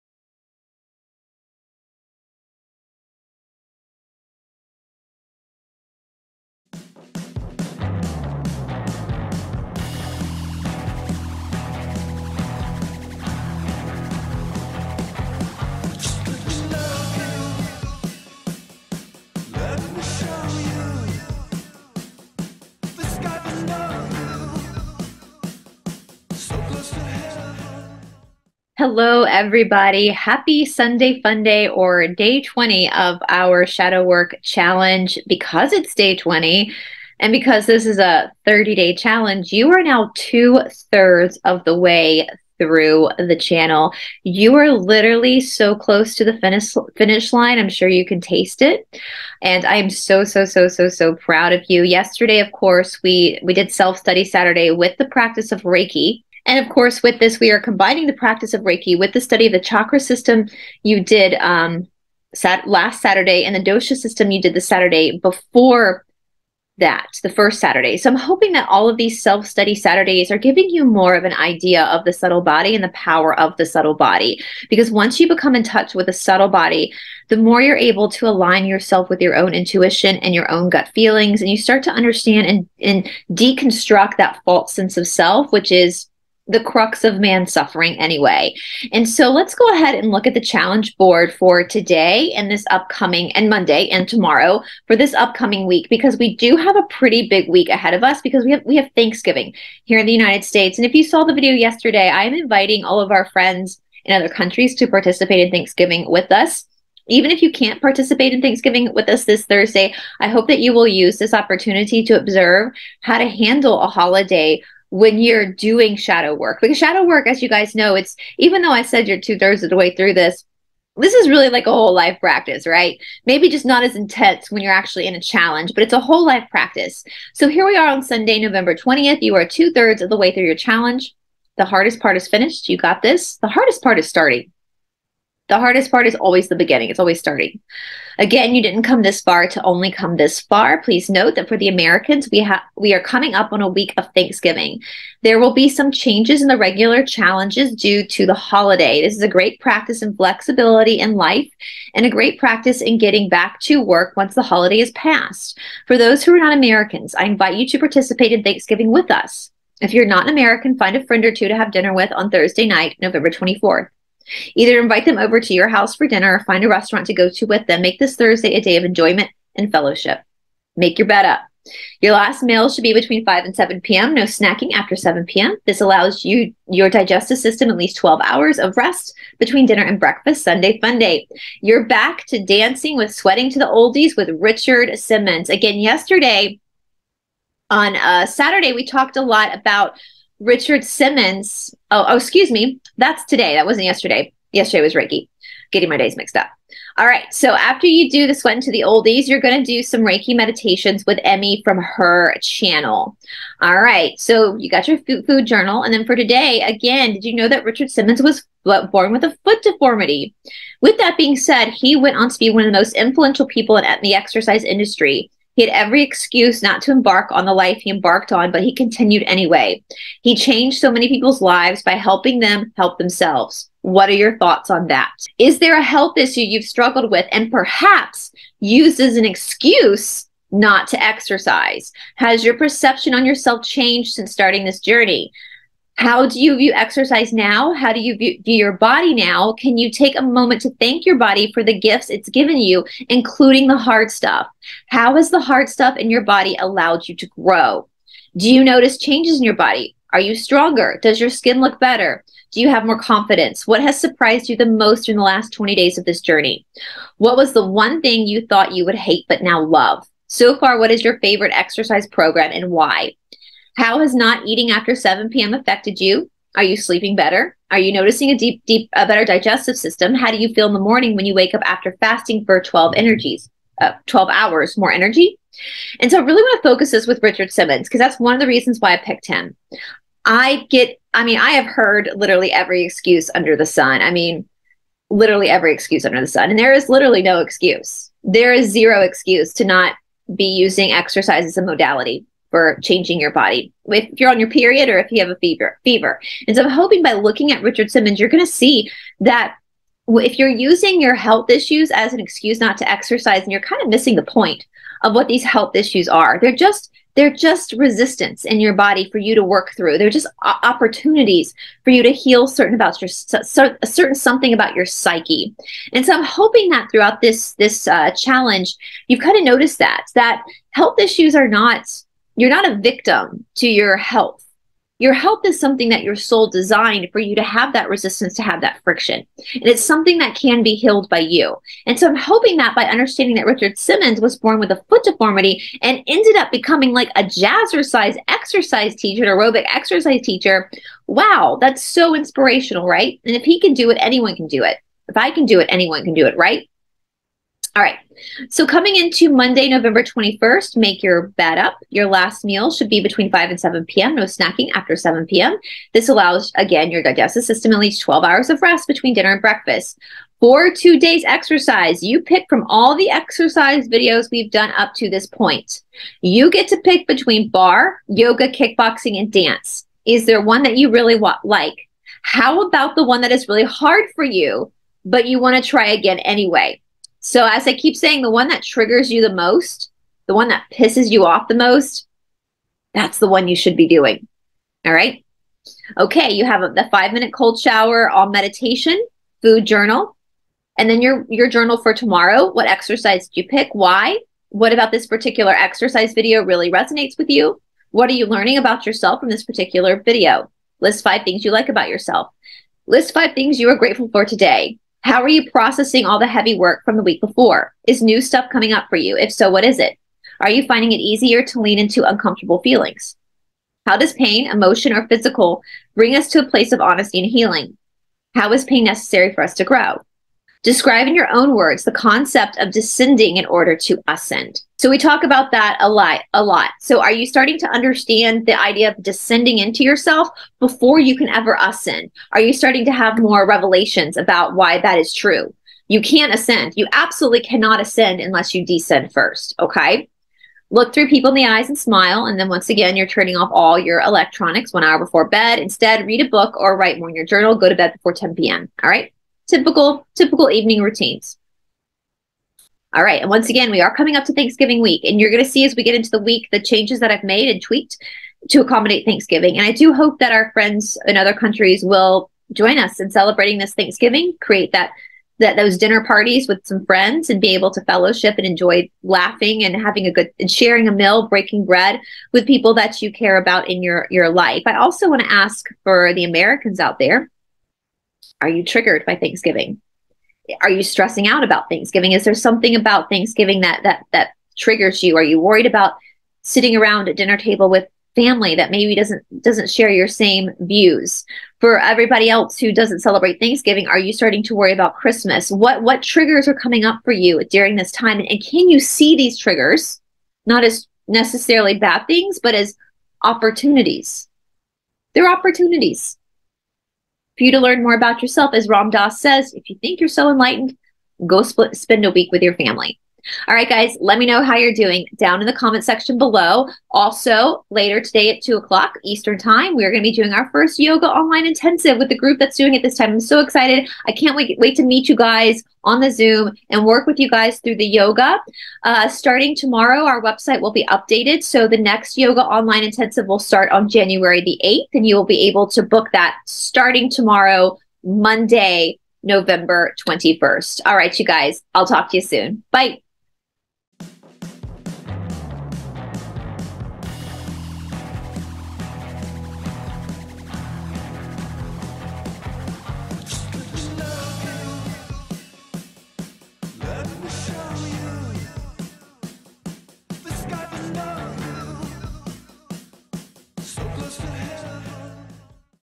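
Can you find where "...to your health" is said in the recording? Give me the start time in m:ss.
5:23.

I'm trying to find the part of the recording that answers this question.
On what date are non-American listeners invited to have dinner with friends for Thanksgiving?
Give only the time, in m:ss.
2:43.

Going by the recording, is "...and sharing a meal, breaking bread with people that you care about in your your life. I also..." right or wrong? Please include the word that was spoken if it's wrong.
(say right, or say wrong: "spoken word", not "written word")
right.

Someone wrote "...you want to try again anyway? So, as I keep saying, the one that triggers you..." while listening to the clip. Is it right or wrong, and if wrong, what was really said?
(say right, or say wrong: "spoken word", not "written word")
right.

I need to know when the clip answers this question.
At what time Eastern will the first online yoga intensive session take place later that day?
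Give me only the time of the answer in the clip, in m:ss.
8:38.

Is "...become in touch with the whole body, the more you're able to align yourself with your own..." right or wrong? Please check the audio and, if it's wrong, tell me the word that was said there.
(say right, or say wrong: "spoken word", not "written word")
wrong: "subtle", not "whole".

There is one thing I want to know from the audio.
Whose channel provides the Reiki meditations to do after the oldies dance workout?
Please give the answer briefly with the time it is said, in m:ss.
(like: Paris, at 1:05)
Emmy, at 3:21.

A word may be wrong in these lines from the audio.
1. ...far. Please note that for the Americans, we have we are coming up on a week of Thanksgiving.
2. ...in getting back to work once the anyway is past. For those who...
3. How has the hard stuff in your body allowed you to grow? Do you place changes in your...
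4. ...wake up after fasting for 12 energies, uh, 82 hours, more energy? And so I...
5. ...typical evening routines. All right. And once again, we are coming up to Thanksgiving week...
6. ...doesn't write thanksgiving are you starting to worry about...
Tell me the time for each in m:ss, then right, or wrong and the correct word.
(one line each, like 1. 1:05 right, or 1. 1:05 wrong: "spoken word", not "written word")
1. 2:20 right
2. 2:32 wrong: "holiday", not "anyway"
3. 4:04 wrong: "notice", not "place"
4. 4:31 wrong: "12", not "82"
5. 7:30 right
6. 8:12 wrong: "celebrate", not "write".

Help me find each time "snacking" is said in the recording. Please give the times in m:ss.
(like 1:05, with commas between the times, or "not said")
2:54, 5:54.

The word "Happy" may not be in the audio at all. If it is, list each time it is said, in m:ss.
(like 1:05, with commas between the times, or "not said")
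0:30.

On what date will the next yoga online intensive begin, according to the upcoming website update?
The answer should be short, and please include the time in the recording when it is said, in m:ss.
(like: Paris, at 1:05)
January 8th, at 8:53.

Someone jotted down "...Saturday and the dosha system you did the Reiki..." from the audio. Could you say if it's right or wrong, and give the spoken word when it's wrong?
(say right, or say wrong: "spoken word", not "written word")
wrong: "Saturday", not "Reiki".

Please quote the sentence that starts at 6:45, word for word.
How are you processing all the heavy work from the week before?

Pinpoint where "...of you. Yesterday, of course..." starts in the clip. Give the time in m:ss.
0:51.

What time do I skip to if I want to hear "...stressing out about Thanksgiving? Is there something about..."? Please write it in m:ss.
8:00.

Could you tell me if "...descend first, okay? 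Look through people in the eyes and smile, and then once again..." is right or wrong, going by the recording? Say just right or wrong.
right.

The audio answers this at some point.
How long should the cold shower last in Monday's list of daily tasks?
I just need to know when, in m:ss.
6:26.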